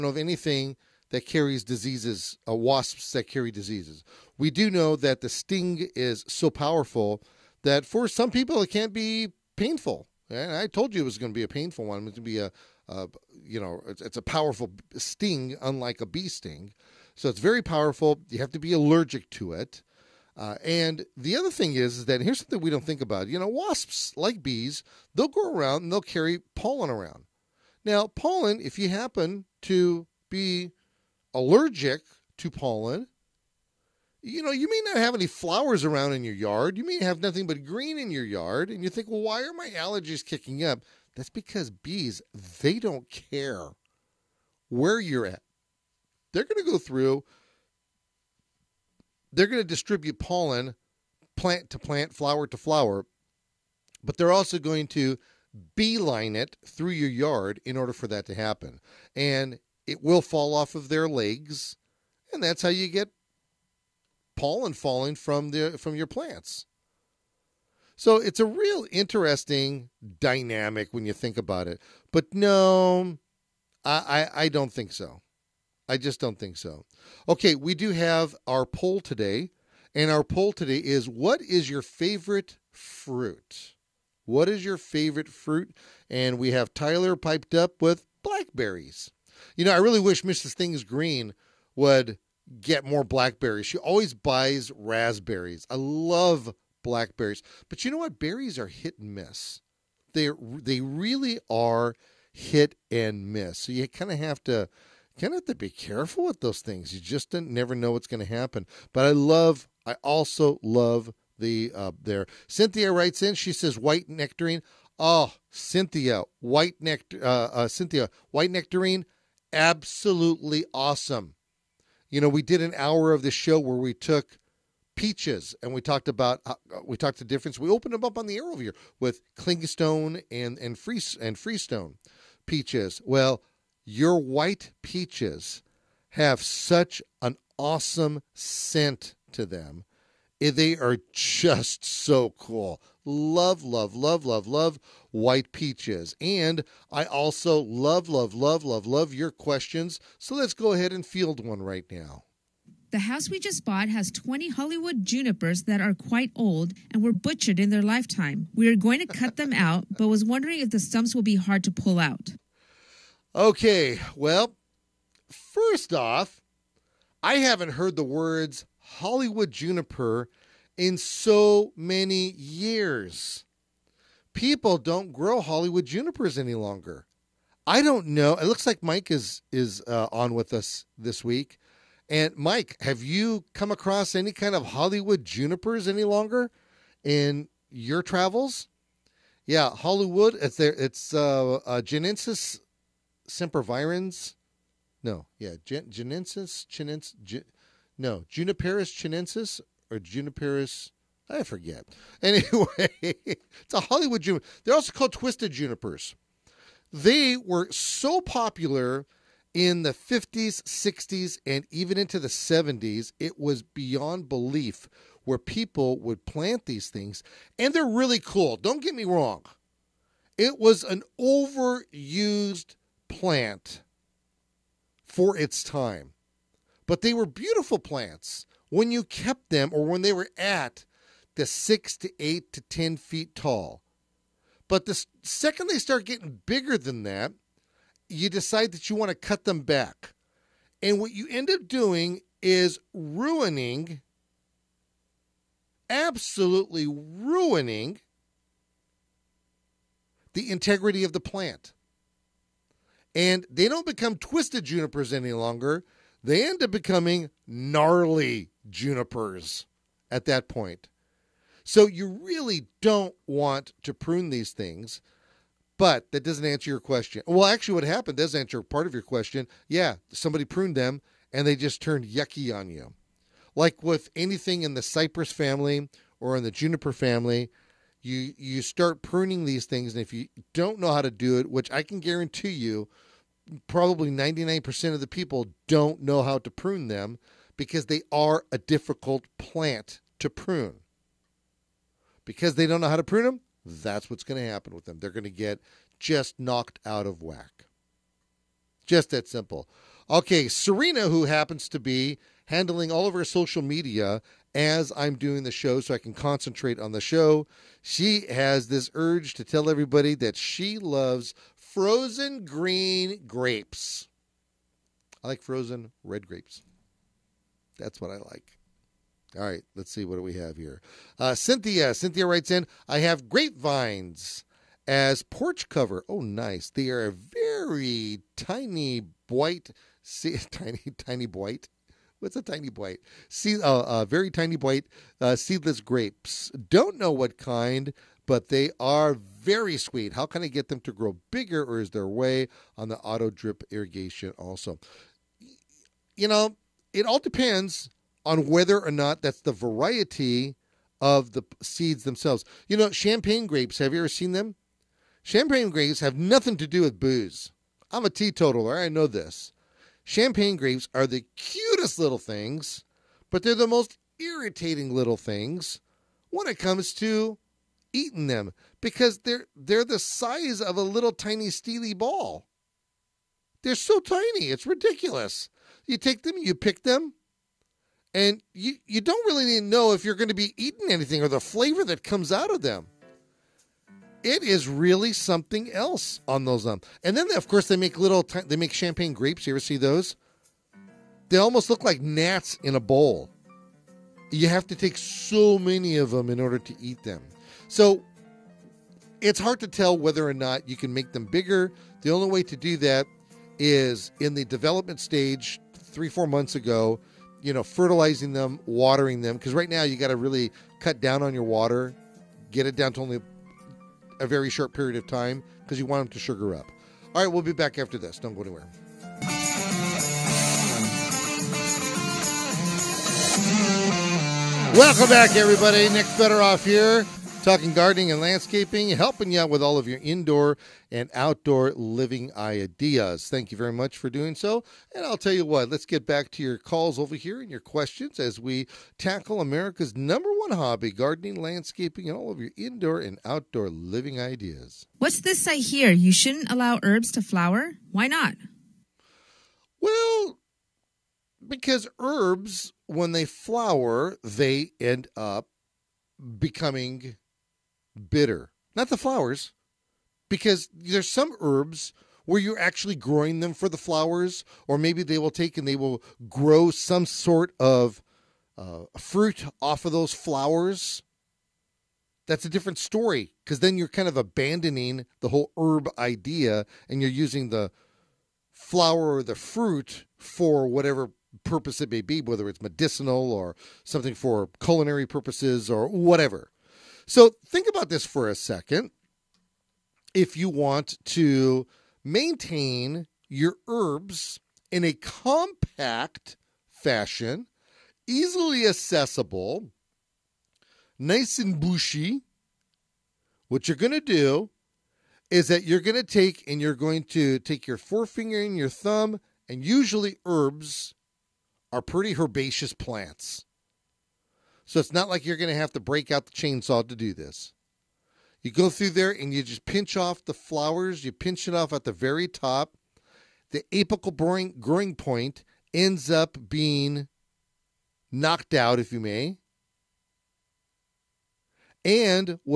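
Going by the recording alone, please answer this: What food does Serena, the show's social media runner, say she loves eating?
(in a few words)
frozen green grapes.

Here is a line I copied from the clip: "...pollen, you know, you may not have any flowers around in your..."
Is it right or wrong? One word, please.
right.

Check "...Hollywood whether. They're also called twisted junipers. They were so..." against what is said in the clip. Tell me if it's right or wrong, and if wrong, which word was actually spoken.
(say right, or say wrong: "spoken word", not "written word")
wrong: "juniper", not "whether".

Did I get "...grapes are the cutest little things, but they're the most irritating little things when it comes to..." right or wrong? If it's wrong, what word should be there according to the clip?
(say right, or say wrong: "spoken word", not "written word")
right.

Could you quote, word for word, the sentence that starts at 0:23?
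You know, wasps, like bees, they'll go around and they'll carry pollen around.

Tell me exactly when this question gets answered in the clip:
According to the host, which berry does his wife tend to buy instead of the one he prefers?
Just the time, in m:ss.
1:34.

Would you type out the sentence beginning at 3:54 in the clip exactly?
But the second they start getting bigger than that, you decide that you want to cut them back.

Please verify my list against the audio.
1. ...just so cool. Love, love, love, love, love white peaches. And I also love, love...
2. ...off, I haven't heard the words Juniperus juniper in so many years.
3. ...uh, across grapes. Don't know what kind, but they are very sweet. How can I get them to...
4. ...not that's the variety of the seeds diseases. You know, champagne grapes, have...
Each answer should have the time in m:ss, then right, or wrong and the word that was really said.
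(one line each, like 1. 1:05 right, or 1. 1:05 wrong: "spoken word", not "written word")
1. 2:21 right
2. 2:45 wrong: "Hollywood", not "Juniperus"
3. 5:35 wrong: "seedless", not "across"
4. 5:48 wrong: "themselves", not "diseases".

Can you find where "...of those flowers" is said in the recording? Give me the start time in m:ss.
7:49.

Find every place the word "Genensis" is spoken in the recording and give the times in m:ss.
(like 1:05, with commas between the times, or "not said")
3:11, 3:15.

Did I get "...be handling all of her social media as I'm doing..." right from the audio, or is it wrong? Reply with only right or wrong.
right.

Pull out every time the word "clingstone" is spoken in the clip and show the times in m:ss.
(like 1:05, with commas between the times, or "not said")
2:09.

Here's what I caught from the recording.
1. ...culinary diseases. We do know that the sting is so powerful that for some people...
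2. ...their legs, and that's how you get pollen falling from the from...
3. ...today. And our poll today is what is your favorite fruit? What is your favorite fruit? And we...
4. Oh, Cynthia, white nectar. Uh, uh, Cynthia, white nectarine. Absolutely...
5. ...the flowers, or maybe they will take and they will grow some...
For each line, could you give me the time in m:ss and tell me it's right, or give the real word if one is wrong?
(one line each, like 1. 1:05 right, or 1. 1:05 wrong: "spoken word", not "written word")
1. 0:03 wrong: "carry", not "culinary"
2. 1:00 right
3. 1:18 right
4. 1:54 right
5. 7:43 right.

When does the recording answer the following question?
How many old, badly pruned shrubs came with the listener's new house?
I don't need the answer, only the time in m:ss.
2:34.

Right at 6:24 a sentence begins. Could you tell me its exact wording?
It is really something else on those um.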